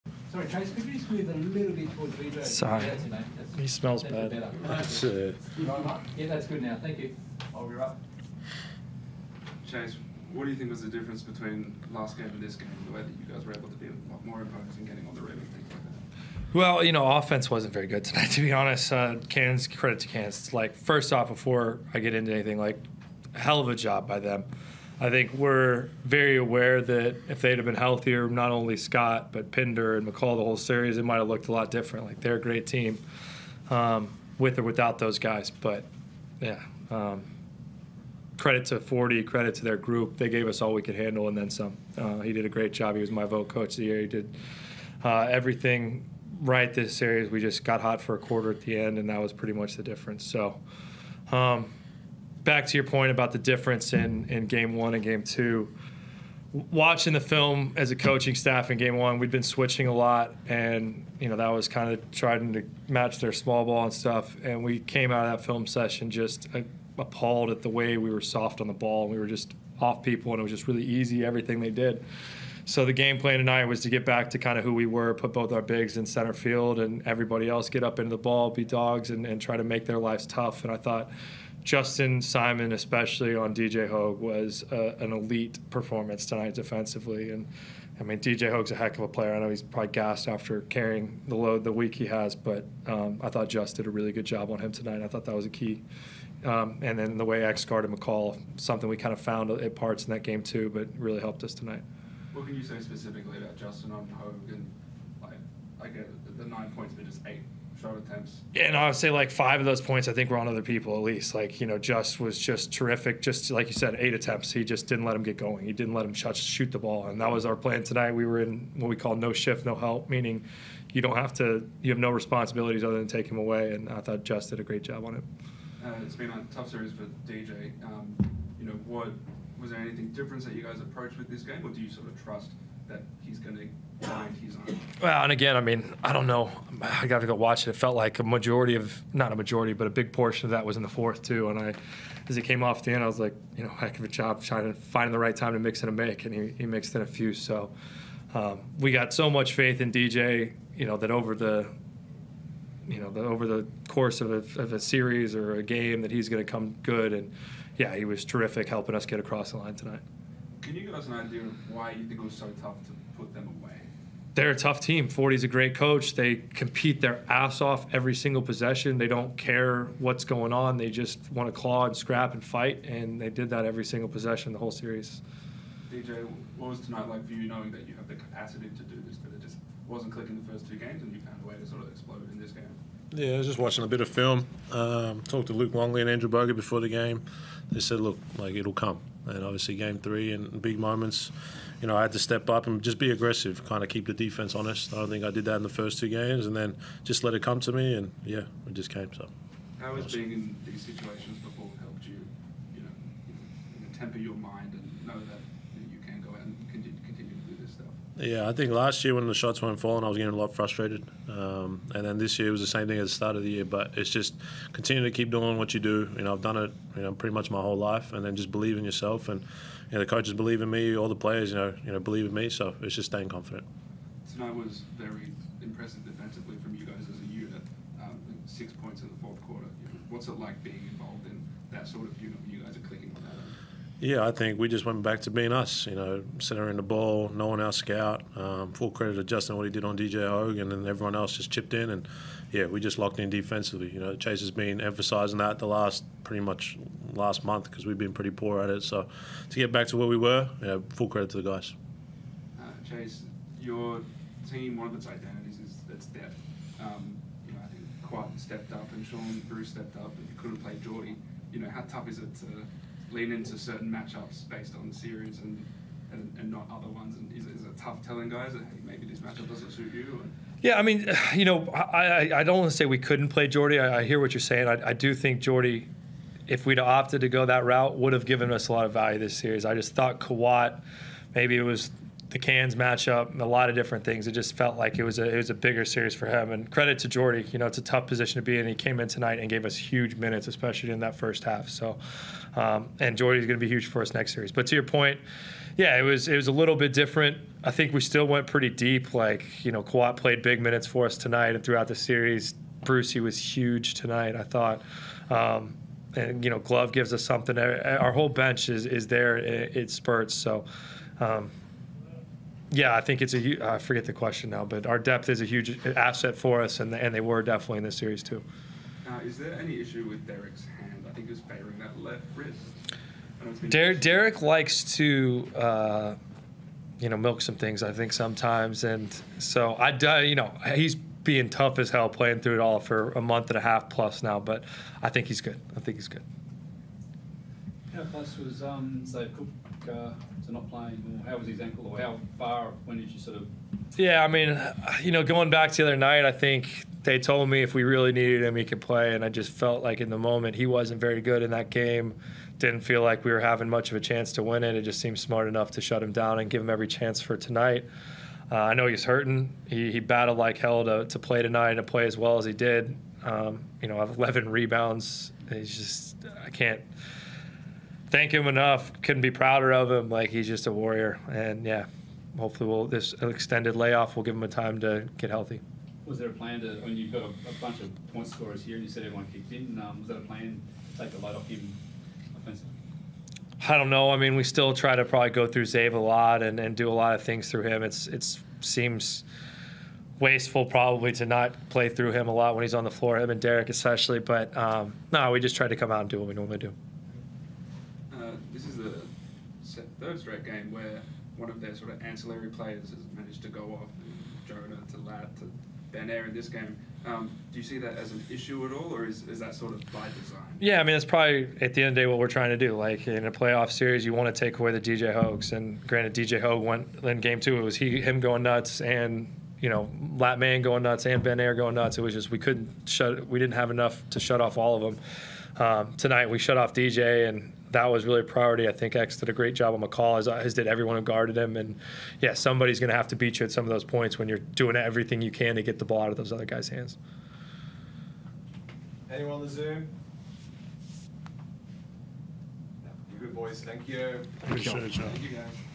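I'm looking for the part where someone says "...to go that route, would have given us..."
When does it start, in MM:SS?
04:37.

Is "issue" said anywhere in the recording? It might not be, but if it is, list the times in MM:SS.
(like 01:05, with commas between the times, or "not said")
05:19, 06:48.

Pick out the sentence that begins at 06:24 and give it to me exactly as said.
I mean, we still try to probably go through Zave a lot and, and do a lot of things through him.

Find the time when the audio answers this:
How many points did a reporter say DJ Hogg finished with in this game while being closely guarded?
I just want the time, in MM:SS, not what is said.
01:46.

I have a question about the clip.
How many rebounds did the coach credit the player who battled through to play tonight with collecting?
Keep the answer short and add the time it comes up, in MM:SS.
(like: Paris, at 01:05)
11, at 06:04.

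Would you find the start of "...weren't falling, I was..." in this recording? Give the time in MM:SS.
03:29.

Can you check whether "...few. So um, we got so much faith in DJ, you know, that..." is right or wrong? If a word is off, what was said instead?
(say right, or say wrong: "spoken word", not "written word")
right.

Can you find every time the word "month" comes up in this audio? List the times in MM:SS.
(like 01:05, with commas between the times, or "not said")
04:07, 05:33.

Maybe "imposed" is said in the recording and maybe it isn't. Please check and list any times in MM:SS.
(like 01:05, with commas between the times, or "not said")
00:14.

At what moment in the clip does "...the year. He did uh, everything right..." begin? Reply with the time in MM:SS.
00:43.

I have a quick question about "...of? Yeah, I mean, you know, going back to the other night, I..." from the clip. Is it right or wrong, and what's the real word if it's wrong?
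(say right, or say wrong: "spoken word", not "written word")
right.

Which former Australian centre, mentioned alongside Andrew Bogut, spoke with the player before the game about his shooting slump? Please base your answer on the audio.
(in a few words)
Luke Longley.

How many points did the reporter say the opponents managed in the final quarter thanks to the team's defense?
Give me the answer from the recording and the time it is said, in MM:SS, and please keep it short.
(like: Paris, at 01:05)
6, at 03:48.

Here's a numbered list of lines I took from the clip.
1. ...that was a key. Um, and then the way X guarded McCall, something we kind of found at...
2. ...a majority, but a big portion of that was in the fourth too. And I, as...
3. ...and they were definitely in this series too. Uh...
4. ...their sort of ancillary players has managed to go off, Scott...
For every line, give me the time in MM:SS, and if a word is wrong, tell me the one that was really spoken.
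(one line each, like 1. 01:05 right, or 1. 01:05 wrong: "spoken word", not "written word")
1. 01:35 right
2. 02:19 right
3. 05:16 right
4. 06:41 wrong: "Jonah", not "Scott".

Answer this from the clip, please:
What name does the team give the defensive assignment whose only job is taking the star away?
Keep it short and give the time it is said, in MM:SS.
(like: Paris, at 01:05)
no shift, no help, at 01:59.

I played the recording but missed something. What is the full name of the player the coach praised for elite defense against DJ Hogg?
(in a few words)
Justin Simon.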